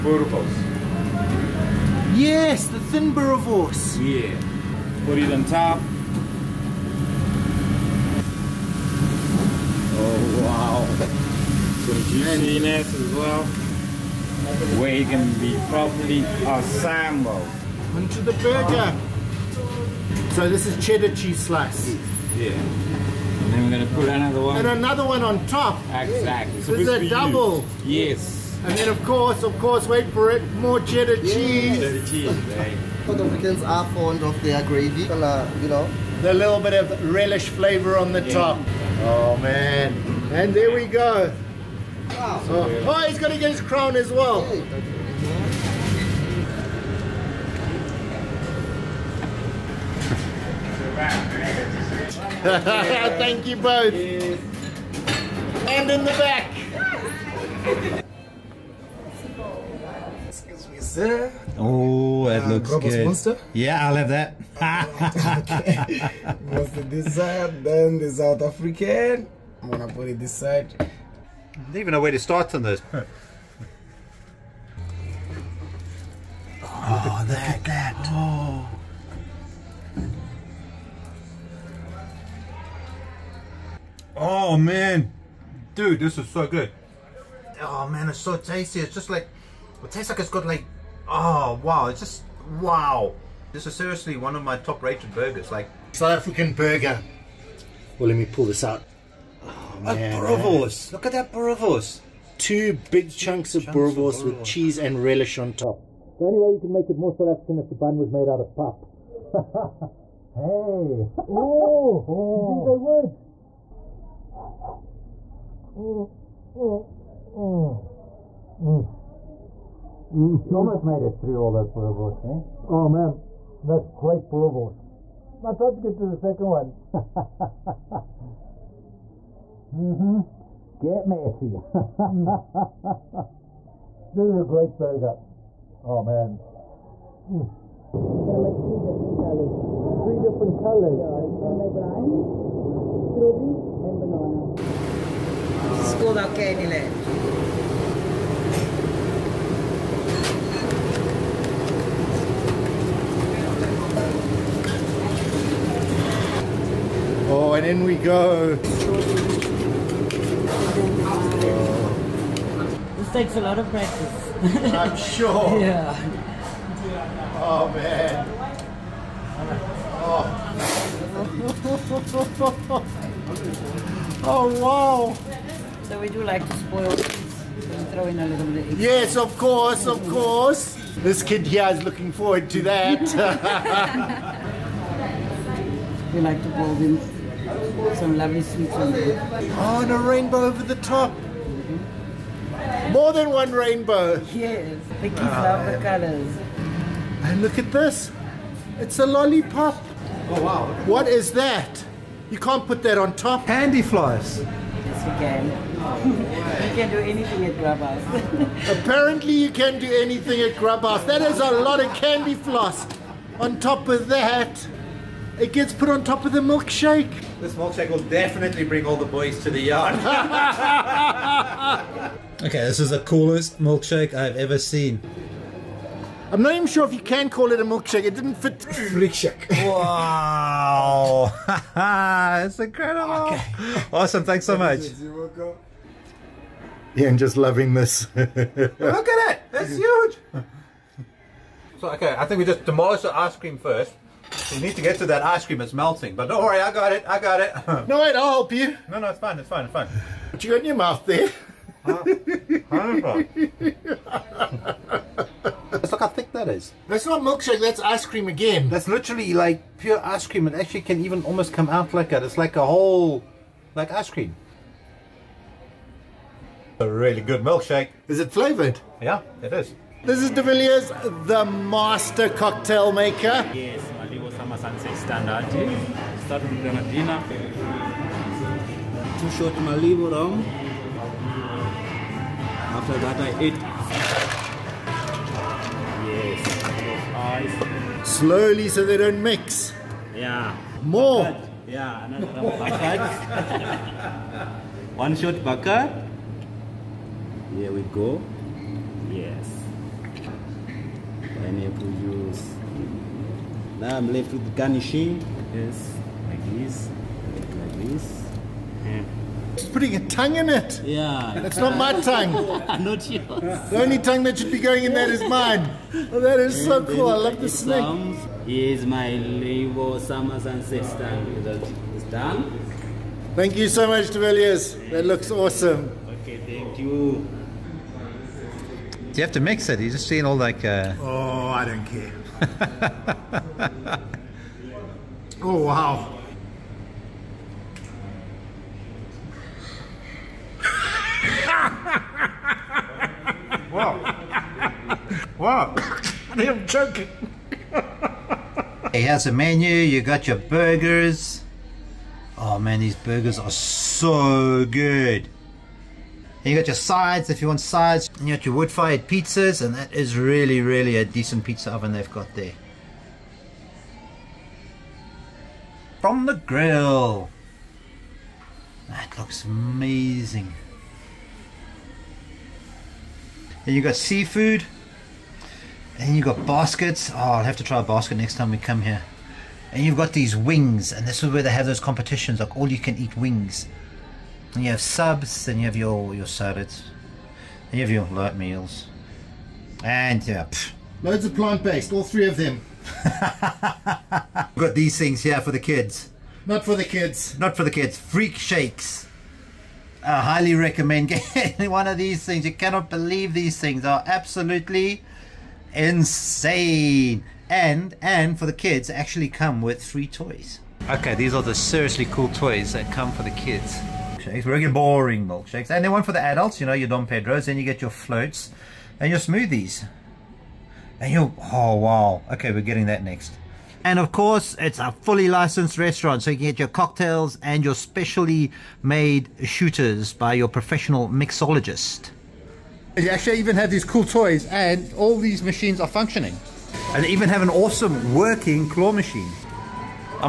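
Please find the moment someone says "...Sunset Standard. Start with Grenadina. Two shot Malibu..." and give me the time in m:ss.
4:34.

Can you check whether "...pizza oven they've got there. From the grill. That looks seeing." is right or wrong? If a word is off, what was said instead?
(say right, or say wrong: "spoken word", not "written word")
wrong: "amazing", not "seeing".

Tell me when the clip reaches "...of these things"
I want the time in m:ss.
6:41.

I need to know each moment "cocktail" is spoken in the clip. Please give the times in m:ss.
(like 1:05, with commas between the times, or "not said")
4:32, 7:06.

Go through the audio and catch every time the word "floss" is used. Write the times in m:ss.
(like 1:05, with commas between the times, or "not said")
3:32.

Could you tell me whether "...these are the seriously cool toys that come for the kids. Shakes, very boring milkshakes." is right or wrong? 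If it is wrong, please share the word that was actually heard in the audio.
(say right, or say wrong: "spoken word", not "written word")
right.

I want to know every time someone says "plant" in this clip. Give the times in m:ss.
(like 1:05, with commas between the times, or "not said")
6:31.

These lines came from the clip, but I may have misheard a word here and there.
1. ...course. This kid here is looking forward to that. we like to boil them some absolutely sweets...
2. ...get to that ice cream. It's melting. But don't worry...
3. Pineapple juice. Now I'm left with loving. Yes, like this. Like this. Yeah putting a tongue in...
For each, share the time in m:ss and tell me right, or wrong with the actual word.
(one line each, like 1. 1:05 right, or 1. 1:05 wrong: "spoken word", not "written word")
1. 3:00 wrong: "lovely", not "absolutely"
2. 4:04 right
3. 5:01 wrong: "garnishing", not "loving".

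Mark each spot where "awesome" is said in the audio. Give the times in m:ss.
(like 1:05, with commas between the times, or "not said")
3:53, 5:25, 7:17.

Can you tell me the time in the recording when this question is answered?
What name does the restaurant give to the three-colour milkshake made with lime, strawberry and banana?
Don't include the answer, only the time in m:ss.
2:26.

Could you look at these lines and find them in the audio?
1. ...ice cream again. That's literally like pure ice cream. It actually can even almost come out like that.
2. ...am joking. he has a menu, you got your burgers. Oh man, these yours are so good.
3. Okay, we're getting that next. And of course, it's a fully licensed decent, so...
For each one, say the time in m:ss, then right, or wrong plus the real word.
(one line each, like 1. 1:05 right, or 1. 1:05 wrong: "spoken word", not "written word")
1. 4:17 right
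2. 5:46 wrong: "burgers", not "yours"
3. 7:02 wrong: "restaurant", not "decent".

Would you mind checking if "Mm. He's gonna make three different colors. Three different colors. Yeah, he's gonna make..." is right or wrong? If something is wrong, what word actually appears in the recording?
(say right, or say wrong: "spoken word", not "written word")
right.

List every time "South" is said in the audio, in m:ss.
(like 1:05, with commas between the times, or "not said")
0:33, 1:08, 1:35, 1:47.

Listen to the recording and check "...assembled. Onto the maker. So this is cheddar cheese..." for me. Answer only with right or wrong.
wrong.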